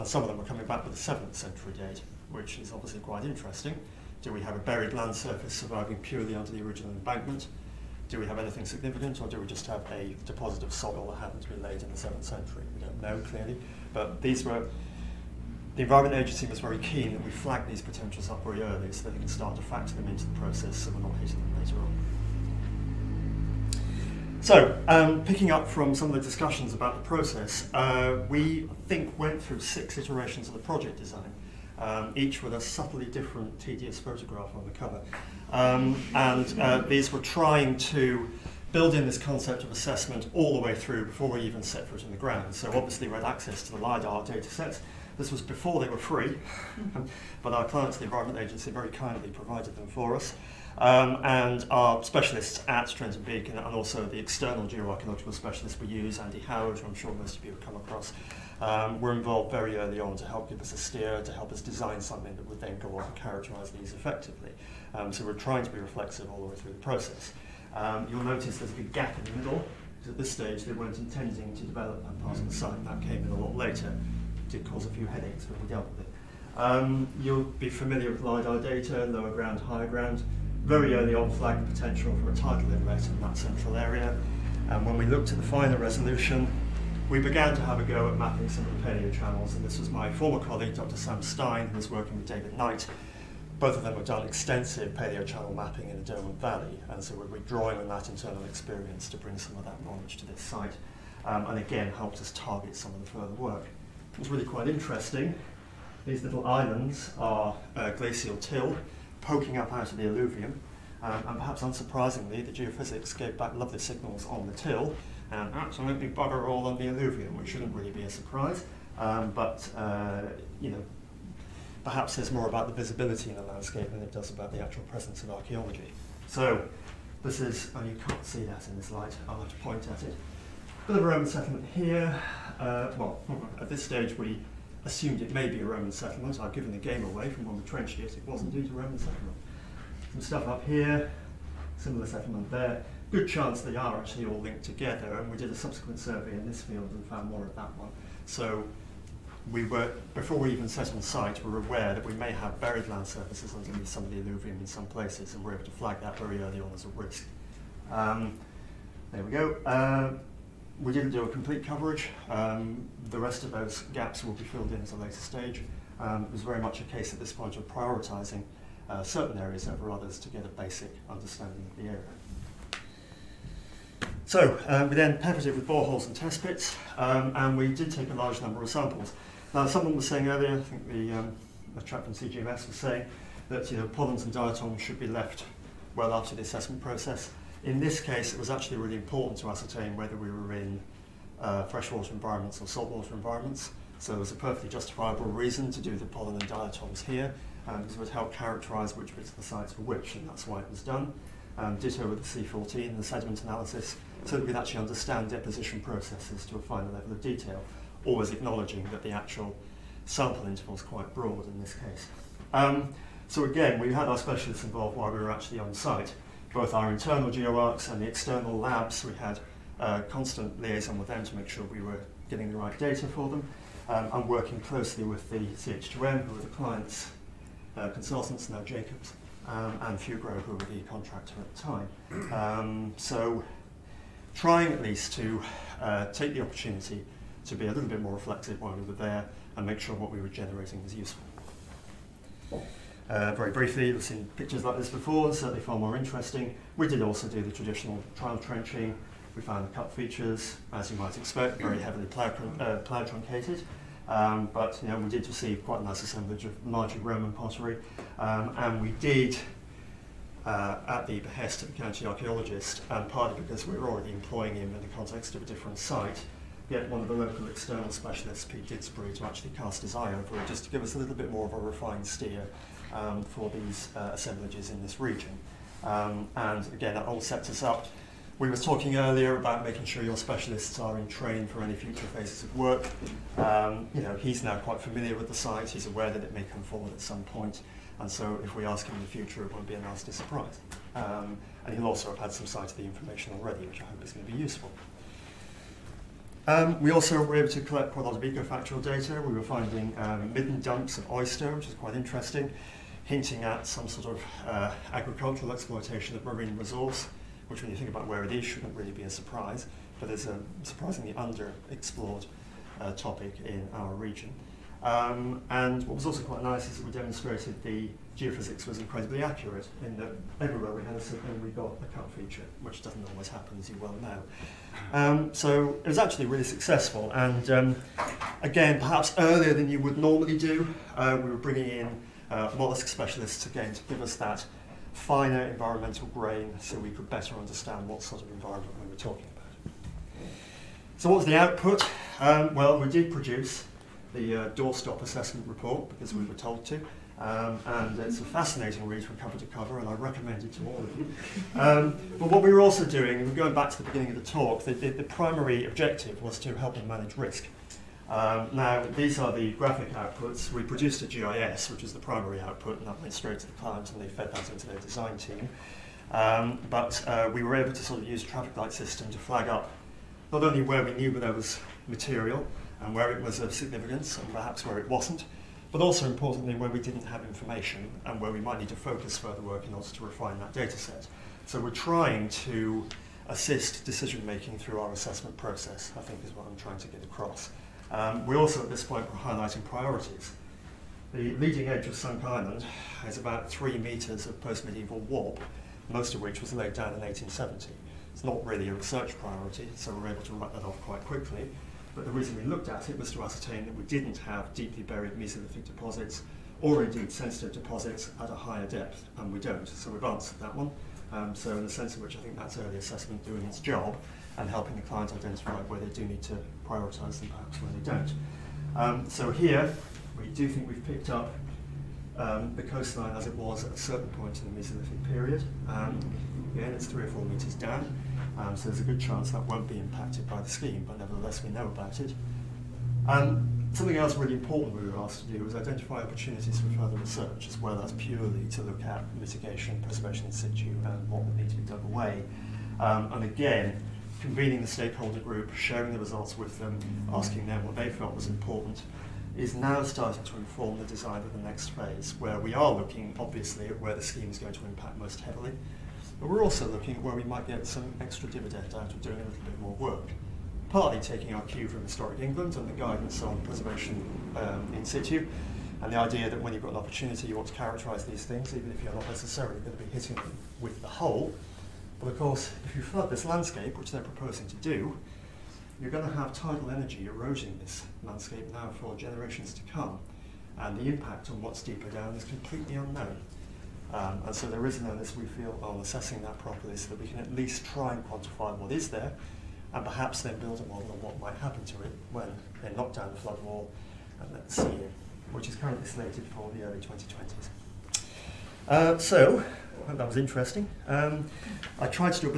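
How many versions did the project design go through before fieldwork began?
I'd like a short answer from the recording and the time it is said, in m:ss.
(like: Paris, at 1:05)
6, at 0:29.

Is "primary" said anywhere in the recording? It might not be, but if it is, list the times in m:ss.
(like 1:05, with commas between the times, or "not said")
5:55, 6:01.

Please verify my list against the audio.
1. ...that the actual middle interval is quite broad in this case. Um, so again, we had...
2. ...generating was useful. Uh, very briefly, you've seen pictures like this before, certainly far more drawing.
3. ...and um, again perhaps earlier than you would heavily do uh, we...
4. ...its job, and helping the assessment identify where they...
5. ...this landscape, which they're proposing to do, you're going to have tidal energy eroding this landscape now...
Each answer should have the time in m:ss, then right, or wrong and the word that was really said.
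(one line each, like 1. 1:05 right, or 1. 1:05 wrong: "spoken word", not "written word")
1. 3:28 wrong: "sample", not "middle"
2. 4:00 wrong: "interesting", not "drawing"
3. 5:27 wrong: "normally", not "heavily"
4. 6:53 wrong: "client", not "assessment"
5. 7:53 right.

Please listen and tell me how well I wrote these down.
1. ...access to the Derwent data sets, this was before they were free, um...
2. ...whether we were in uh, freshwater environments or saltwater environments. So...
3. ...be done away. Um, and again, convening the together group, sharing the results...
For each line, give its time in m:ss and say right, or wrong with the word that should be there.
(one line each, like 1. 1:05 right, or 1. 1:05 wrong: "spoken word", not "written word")
1. 0:43 wrong: "LiDAR", not "Derwent"
2. 3:09 right
3. 7:21 wrong: "stakeholder", not "together".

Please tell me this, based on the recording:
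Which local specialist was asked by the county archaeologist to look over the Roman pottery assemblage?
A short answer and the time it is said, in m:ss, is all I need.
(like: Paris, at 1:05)
Pete Didsbury, at 4:28.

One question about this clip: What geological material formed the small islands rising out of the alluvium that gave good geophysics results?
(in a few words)
glacial till.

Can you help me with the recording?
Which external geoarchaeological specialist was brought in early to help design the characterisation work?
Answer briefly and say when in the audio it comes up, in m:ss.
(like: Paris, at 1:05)
Andy Howard, at 0:56.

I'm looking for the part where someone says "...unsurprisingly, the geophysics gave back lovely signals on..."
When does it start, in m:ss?
1:51.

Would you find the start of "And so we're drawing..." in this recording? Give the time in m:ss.
1:36.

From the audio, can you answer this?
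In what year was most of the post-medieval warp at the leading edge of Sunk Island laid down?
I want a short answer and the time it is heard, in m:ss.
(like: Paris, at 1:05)
1870, at 6:37.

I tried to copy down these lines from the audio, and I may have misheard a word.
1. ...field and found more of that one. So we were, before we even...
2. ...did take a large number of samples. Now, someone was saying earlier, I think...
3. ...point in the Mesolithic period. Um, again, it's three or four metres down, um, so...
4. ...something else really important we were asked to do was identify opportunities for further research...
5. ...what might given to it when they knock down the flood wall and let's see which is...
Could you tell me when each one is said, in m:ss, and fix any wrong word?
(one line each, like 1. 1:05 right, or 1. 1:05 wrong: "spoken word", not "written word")
1. 2:26 right
2. 2:57 right
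3. 7:04 right
4. 7:13 right
5. 8:11 wrong: "happen", not "given".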